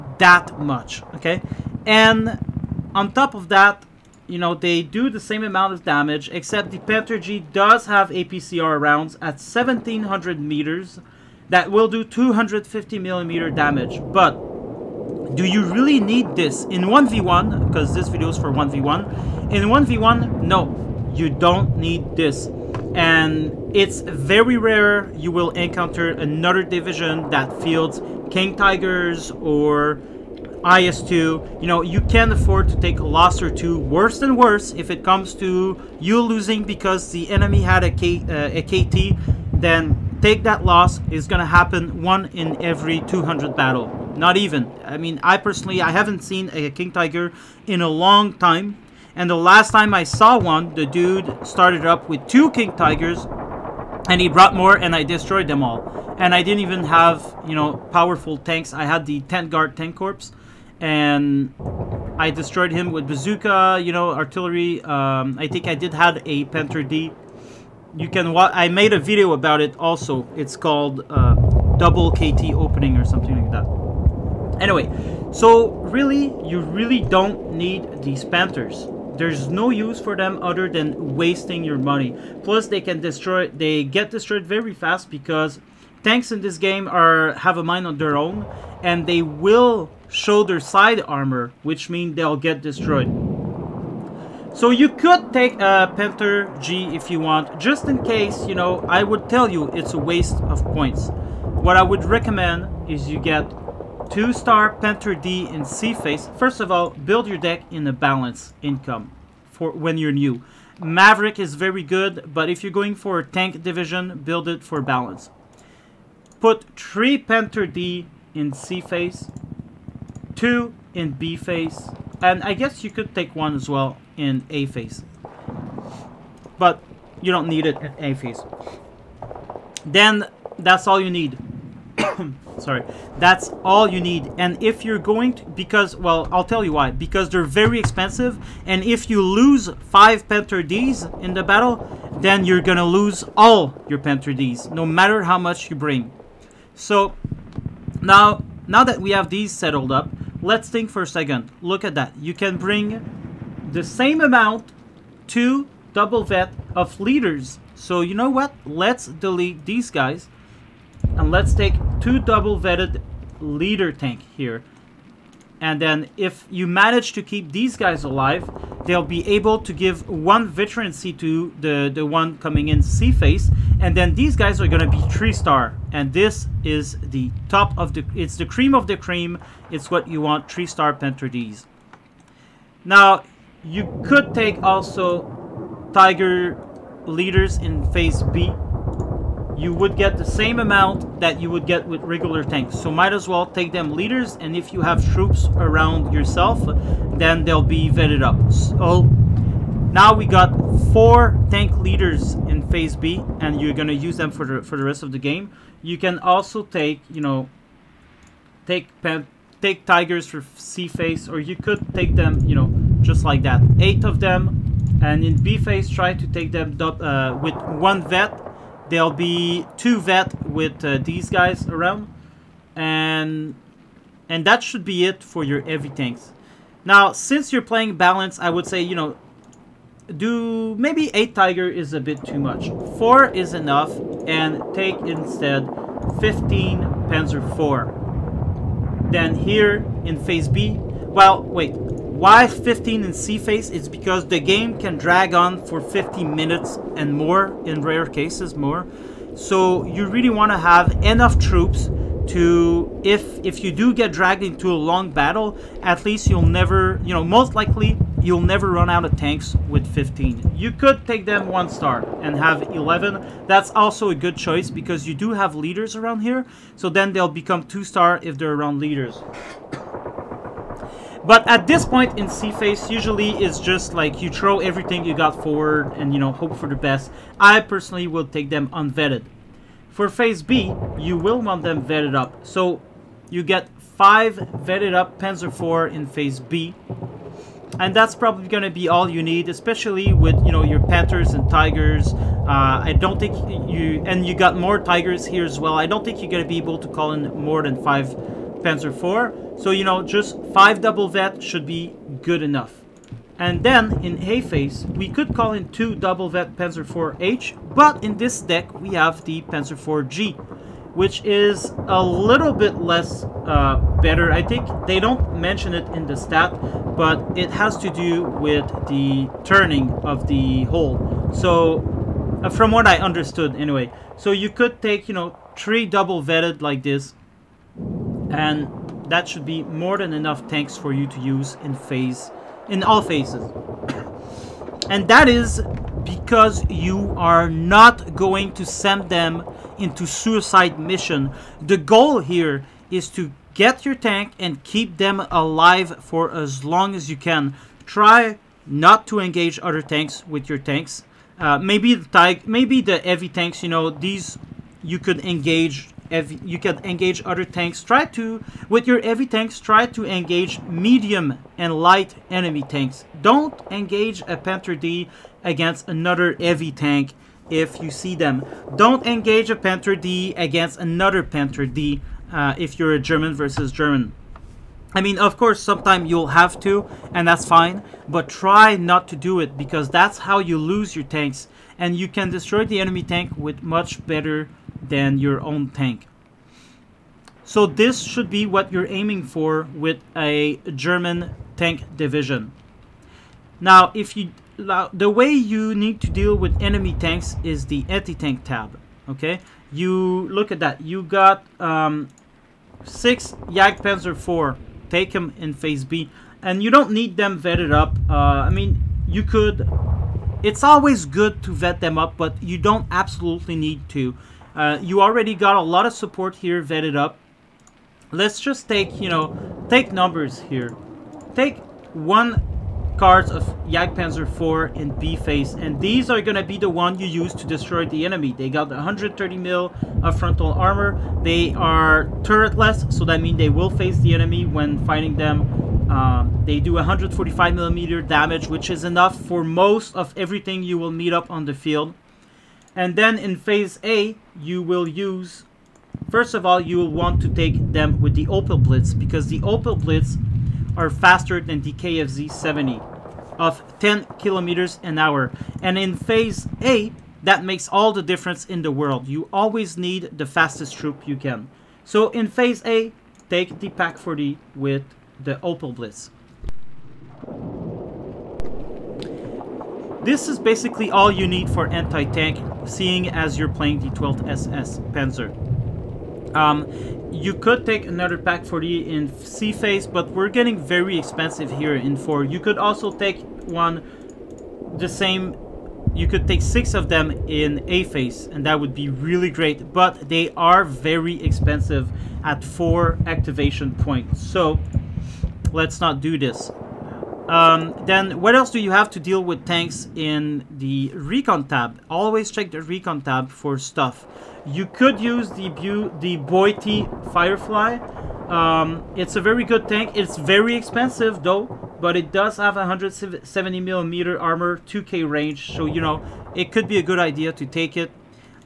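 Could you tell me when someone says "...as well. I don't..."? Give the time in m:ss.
4:55.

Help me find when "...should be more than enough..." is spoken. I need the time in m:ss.
5:29.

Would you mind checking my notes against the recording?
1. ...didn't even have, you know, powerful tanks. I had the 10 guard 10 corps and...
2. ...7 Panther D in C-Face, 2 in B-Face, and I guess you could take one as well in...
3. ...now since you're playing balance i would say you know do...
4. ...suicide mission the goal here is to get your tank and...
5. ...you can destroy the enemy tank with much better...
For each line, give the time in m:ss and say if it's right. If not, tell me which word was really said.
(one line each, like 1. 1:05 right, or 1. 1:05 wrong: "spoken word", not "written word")
1. 0:56 right
2. 1:56 wrong: "3", not "7"
3. 3:46 right
4. 5:40 right
5. 6:21 right.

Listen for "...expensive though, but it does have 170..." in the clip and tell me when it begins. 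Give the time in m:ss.
8:30.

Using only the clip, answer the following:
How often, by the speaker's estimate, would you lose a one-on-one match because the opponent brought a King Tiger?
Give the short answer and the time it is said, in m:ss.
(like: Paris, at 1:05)
one in every 200 battles, at 0:42.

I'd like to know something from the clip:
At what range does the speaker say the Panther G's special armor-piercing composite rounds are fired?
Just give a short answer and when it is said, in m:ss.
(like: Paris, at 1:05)
1700 meters, at 0:09.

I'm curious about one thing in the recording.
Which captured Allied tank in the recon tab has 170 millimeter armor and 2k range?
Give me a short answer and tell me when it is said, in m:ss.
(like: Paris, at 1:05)
Beute Firefly, at 8:26.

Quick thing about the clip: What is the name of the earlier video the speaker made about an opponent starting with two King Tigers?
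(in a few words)
Double KT Opening.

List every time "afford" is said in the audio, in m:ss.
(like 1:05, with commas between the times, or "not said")
0:32.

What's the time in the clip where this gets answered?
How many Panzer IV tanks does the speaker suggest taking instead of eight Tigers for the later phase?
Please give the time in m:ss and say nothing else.
3:56.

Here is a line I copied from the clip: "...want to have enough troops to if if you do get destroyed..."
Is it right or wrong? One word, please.
wrong.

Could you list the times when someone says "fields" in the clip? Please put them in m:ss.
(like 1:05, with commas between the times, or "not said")
0:27, 7:21.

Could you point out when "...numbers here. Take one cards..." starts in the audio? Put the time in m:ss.
6:59.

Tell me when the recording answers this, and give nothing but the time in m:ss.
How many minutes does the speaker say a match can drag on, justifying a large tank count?
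4:05.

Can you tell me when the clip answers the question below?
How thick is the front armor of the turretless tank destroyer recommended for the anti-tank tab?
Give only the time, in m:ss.
7:08.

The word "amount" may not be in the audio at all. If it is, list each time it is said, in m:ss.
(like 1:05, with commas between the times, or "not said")
0:05, 2:34, 3:10.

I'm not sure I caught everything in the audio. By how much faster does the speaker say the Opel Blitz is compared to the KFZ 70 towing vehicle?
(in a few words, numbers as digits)
10 km/h.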